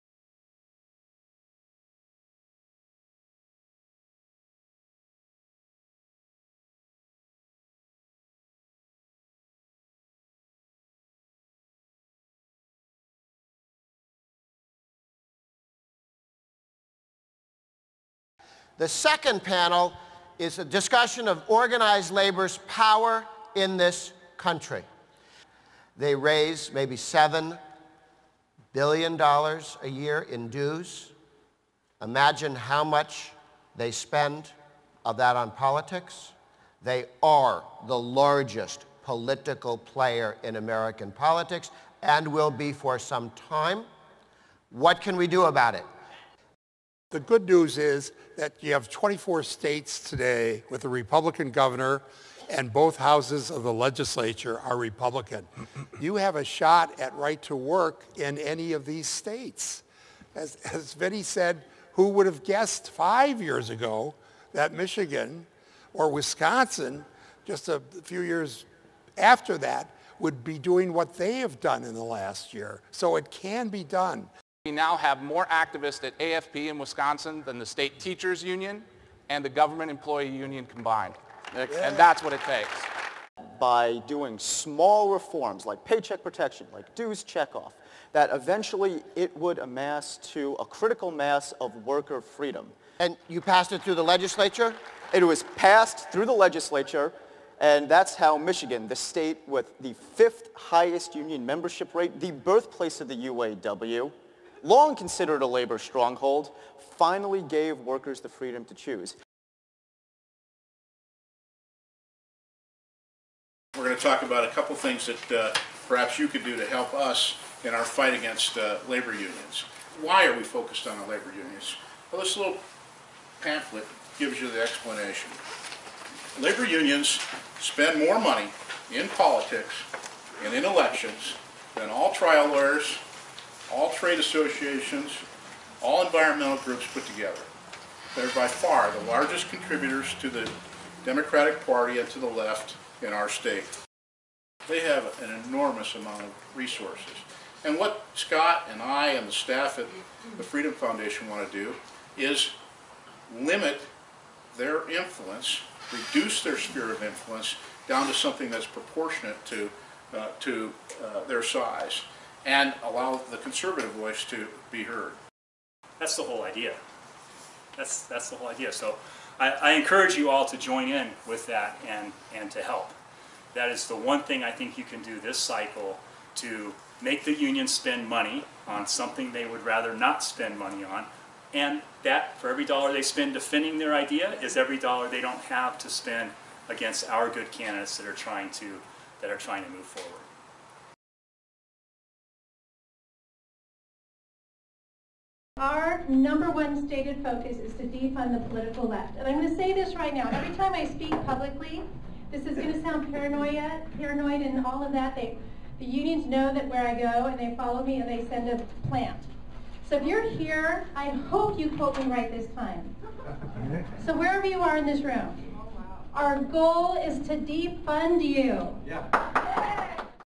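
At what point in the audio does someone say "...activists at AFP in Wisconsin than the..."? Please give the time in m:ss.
1:15.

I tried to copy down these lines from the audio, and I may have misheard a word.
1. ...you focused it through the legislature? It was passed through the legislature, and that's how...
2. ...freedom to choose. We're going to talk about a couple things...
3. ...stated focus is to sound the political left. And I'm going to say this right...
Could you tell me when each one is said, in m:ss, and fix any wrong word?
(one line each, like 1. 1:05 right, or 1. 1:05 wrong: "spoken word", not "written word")
1. 1:33 wrong: "passed", not "focused"
2. 1:48 right
3. 3:16 wrong: "defund", not "sound".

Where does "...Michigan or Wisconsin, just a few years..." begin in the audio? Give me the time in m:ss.
1:04.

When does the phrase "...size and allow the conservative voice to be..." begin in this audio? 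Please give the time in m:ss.
2:41.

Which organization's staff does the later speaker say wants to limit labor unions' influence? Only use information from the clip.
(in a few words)
Freedom Foundation.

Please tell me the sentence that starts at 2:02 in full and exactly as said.
Well, this little pamphlet gives you the explanation.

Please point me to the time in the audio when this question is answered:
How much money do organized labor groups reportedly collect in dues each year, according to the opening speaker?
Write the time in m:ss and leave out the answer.
0:26.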